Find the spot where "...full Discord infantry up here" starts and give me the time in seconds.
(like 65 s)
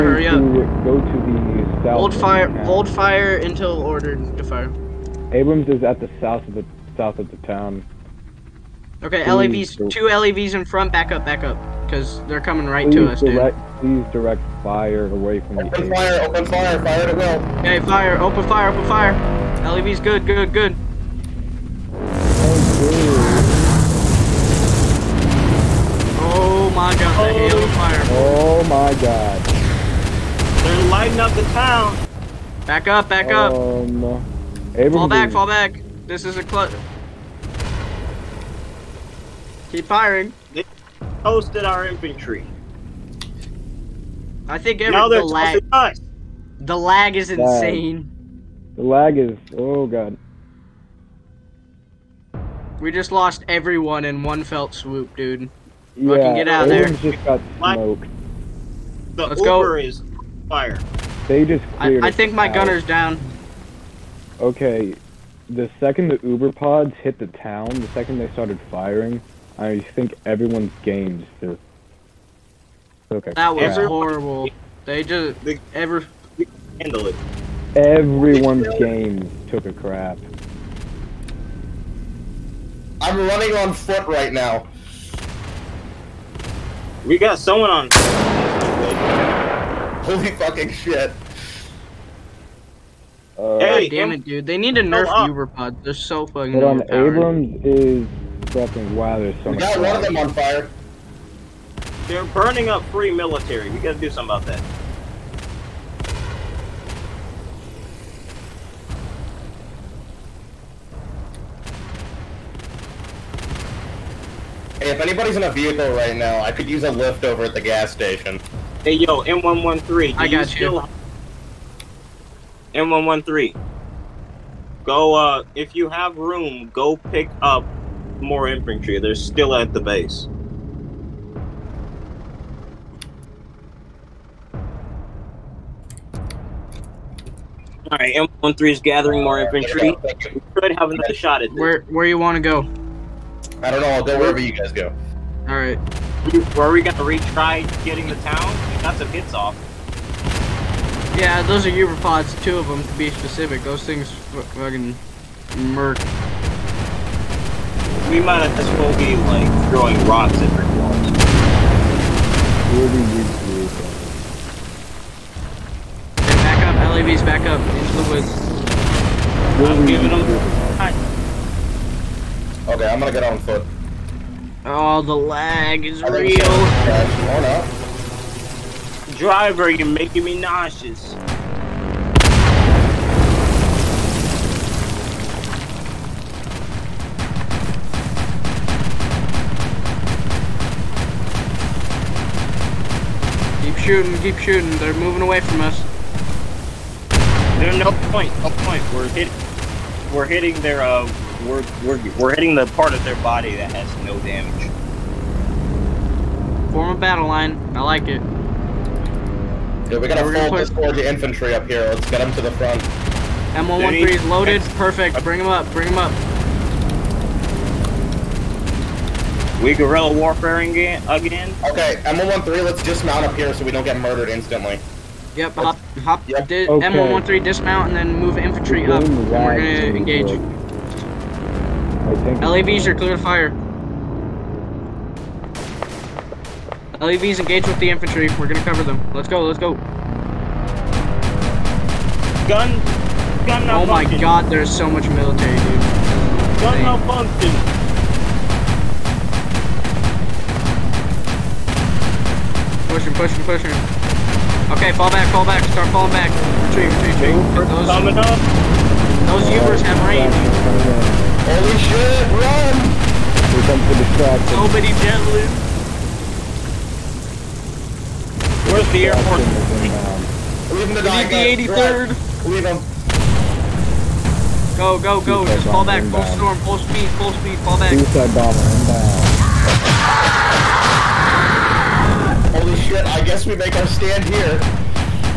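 210 s.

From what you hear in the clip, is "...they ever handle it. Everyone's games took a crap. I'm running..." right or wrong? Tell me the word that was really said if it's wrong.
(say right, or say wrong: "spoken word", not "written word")
right.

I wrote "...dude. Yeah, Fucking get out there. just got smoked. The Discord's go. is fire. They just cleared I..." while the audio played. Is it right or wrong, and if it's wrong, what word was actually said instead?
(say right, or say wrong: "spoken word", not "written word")
wrong: "Let", not "Discord".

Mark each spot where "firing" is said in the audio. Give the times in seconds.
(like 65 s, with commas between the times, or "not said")
39 s, 68 s.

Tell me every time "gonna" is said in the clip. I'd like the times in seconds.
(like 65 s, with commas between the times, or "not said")
146 s, 172 s, 229 s, 238 s.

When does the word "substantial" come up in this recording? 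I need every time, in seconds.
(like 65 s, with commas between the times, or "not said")
not said.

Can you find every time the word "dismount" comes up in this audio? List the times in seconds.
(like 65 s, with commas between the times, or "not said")
222 s, 227 s.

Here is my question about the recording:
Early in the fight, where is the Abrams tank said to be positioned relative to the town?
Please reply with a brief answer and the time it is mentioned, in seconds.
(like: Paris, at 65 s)
South of the town, at 5 s.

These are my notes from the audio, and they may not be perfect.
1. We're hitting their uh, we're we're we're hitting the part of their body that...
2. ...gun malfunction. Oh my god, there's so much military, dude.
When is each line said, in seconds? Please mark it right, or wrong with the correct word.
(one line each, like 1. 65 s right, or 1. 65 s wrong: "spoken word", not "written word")
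1. 200 s right
2. 243 s right.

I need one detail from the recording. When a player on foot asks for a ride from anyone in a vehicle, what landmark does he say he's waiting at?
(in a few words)
The gas station.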